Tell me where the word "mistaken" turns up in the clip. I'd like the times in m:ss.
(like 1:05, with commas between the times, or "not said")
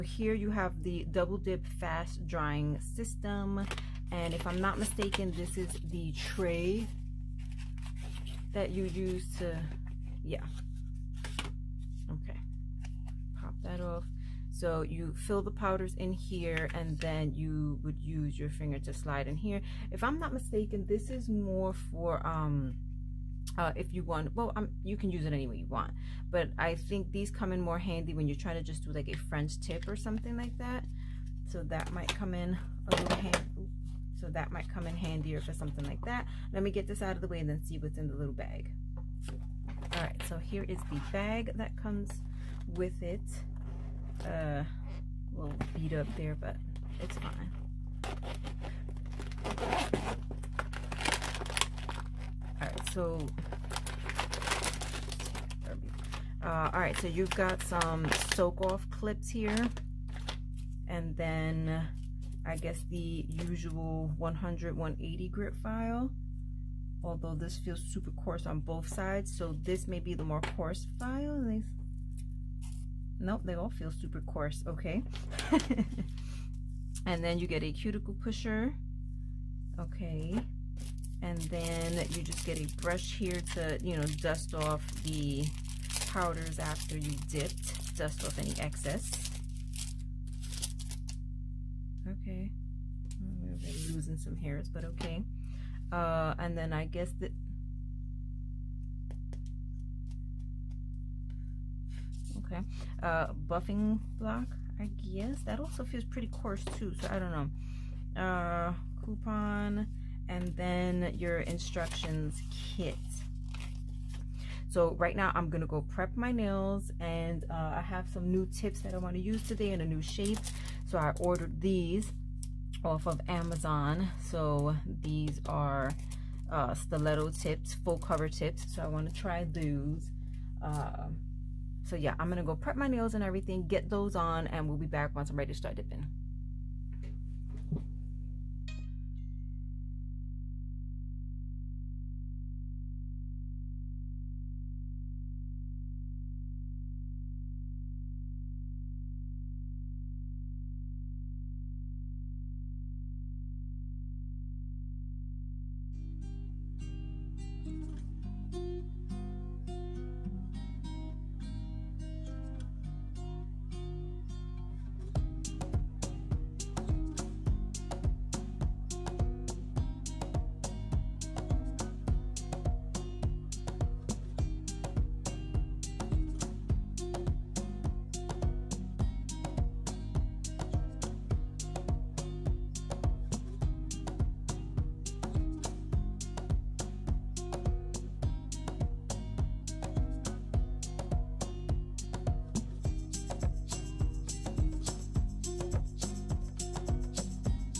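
0:04, 0:20.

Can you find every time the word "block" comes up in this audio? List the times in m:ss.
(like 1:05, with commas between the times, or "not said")
1:44.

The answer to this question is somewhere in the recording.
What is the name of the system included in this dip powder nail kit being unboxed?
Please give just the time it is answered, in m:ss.
0:01.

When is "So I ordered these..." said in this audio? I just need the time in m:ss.
2:00.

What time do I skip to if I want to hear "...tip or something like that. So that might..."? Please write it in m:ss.
0:29.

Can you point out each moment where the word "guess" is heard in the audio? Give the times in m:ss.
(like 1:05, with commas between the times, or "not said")
1:02, 1:36, 1:45.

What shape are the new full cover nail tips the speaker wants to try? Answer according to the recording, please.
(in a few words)
Stiletto.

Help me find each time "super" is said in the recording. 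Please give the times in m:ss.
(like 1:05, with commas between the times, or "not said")
1:07, 1:13.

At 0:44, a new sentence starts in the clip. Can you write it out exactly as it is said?
Uh, a little beat up there, but it's fine.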